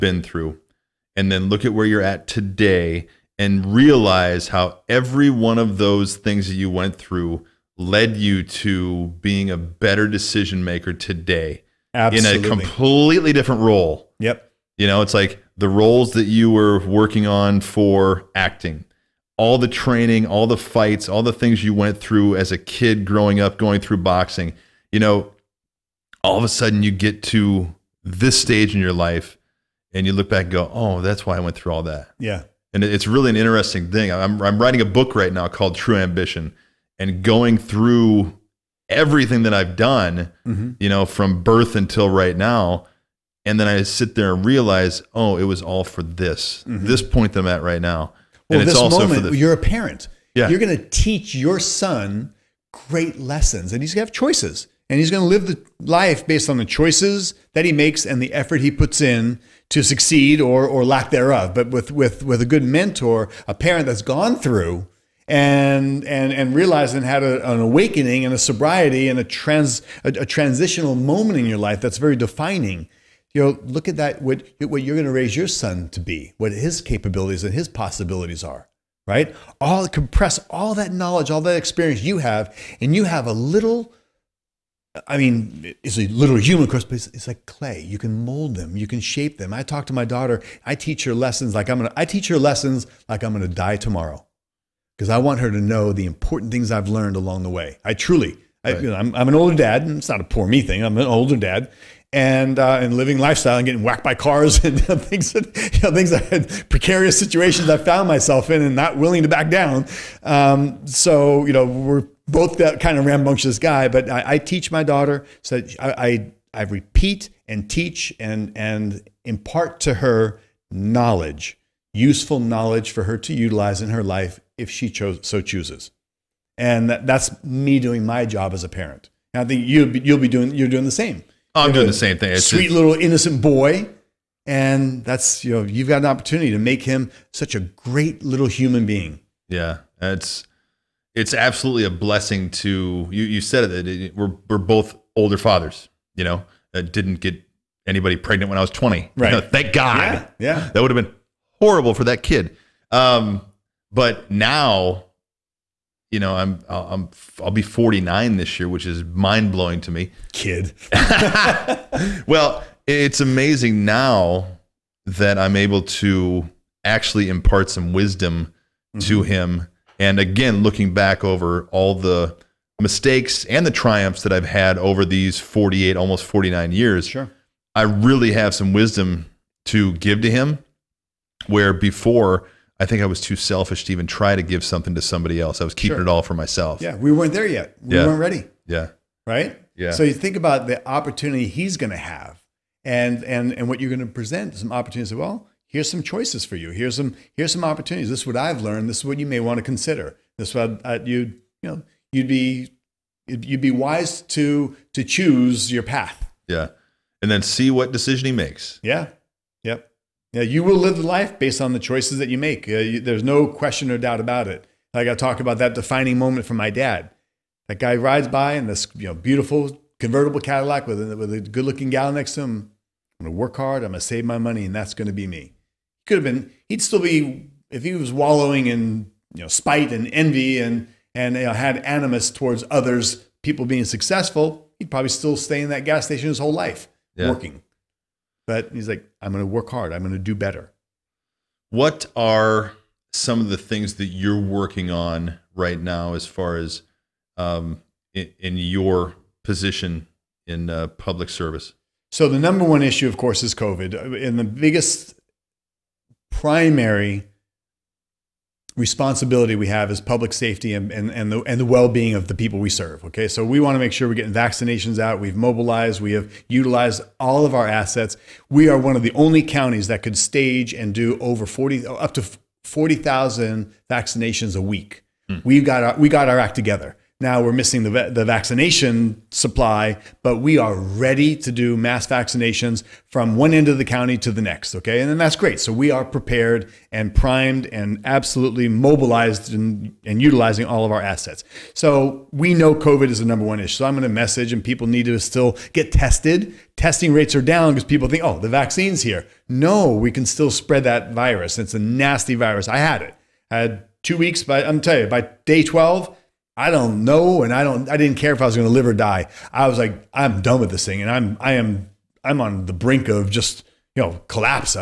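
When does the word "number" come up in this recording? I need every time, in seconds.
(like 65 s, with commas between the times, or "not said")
252 s, 293 s.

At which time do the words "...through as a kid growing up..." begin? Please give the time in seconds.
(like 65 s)
21 s.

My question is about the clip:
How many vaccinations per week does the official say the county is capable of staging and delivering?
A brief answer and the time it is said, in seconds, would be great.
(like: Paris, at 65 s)
40,000, at 272 s.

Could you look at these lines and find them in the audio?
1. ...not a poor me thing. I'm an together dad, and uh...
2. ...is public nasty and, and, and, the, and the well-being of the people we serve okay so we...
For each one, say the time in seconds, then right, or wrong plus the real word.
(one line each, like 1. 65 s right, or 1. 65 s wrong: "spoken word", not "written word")
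1. 100 s wrong: "older", not "together"
2. 259 s wrong: "safety", not "nasty".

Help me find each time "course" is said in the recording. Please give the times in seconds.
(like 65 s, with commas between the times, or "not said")
86 s, 253 s.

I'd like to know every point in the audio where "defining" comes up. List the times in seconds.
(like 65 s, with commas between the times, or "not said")
72 s, 215 s.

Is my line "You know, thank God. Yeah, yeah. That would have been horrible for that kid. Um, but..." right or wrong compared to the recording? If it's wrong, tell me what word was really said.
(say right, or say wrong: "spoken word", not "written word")
right.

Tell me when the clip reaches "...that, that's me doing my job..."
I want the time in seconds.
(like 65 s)
126 s.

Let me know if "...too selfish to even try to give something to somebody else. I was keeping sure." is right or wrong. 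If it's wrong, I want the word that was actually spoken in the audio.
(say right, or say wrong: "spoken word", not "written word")
right.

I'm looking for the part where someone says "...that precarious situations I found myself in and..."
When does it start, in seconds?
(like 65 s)
106 s.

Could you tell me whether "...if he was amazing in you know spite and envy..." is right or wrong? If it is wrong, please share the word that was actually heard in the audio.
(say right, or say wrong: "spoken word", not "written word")
wrong: "wallowing", not "amazing".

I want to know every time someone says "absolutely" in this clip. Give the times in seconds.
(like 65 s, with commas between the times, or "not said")
11 s, 141 s, 288 s.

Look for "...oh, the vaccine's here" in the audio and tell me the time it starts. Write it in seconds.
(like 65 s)
298 s.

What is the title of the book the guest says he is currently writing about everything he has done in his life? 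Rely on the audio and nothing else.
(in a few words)
True Ambition.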